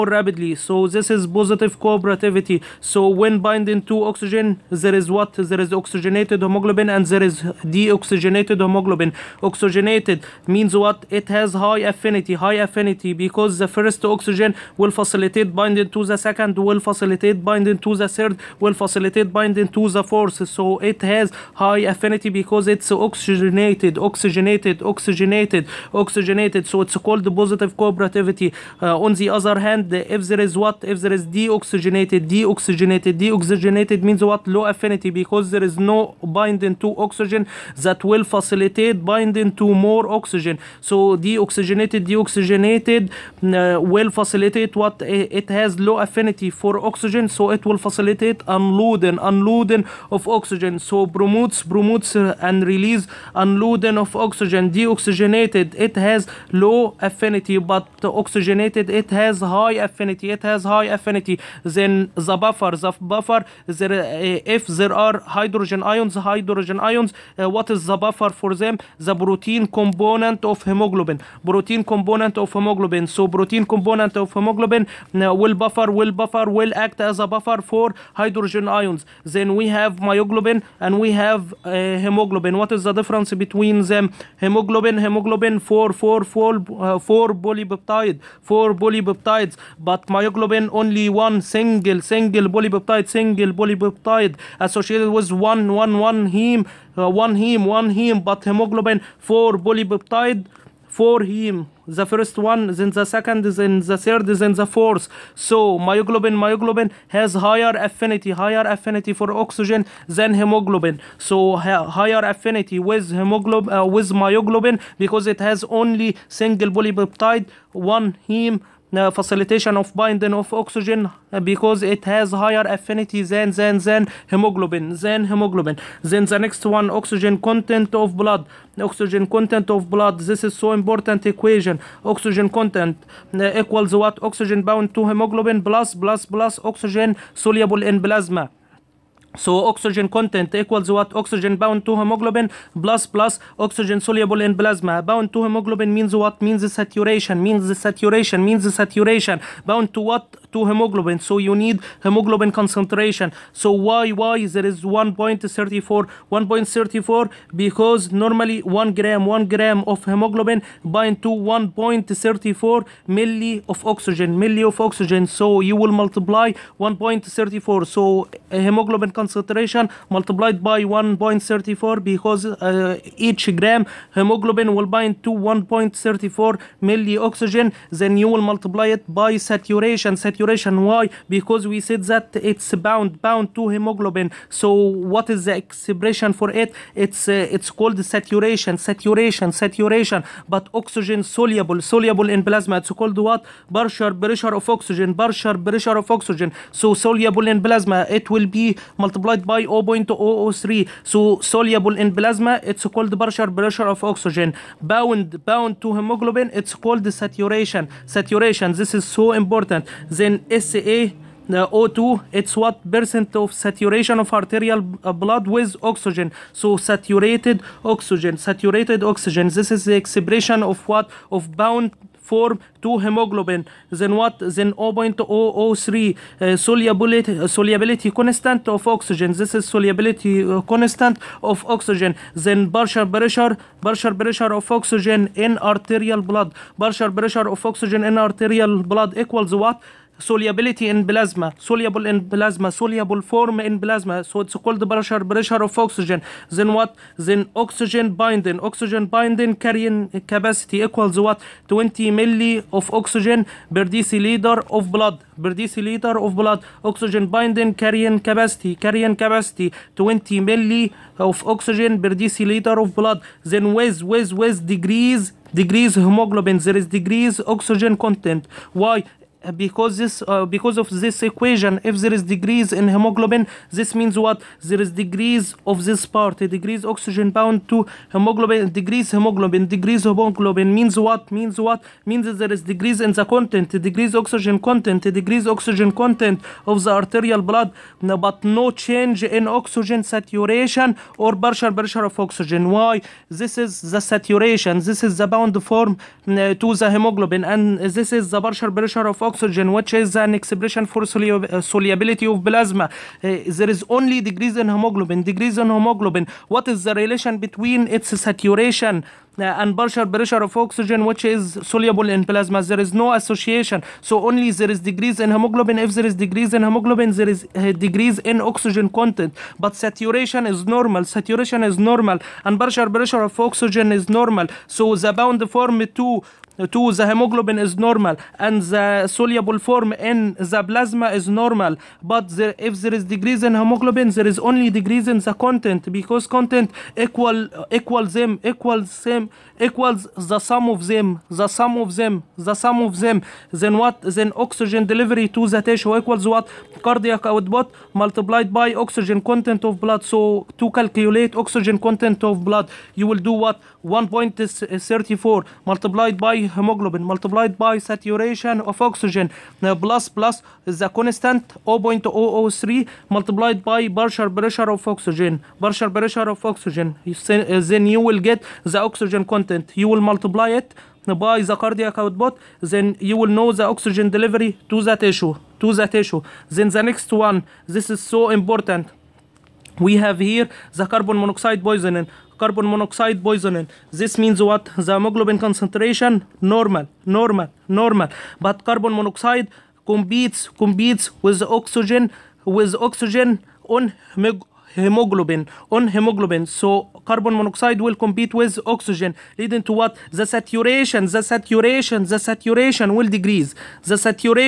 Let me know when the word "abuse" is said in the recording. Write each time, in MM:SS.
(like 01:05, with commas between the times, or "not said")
not said.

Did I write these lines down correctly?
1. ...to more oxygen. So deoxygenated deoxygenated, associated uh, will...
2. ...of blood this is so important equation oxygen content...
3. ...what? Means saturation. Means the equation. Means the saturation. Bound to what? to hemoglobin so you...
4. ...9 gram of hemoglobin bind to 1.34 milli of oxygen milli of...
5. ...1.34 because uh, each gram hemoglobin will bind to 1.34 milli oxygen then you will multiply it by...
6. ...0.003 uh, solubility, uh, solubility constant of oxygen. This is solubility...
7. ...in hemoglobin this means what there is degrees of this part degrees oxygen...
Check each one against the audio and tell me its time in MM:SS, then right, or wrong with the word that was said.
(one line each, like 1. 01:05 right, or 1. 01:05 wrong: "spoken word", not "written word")
1. 00:39 wrong: "deoxygenated", not "associated"
2. 02:09 right
3. 02:26 wrong: "saturation", not "equation"
4. 02:39 wrong: "1", not "9"
5. 02:50 right
6. 03:44 right
7. 04:32 right.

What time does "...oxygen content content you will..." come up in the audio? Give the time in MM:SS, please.
06:08.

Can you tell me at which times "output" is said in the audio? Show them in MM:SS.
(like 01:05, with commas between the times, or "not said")
05:47, 06:11.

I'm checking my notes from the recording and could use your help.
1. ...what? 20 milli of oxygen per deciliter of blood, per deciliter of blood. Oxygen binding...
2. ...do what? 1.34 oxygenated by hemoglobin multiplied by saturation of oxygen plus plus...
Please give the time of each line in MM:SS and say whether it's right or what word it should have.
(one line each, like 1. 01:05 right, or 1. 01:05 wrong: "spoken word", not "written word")
1. 04:11 right
2. 05:53 wrong: "multiplied", not "oxygenated".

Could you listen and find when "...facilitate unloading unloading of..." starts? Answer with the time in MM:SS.
00:47.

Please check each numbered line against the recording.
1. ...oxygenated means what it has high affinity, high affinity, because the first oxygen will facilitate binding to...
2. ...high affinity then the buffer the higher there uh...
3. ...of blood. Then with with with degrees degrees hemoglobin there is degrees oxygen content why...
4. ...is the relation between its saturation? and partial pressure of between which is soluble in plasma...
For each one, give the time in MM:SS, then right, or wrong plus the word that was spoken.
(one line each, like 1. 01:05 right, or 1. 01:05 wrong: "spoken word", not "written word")
1. 00:09 right
2. 01:00 wrong: "buffer", not "higher"
3. 04:22 right
4. 05:06 wrong: "oxygen", not "between".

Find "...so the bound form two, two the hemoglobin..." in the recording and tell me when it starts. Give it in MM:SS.
05:24.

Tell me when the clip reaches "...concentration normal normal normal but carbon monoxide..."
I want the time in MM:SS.
06:25.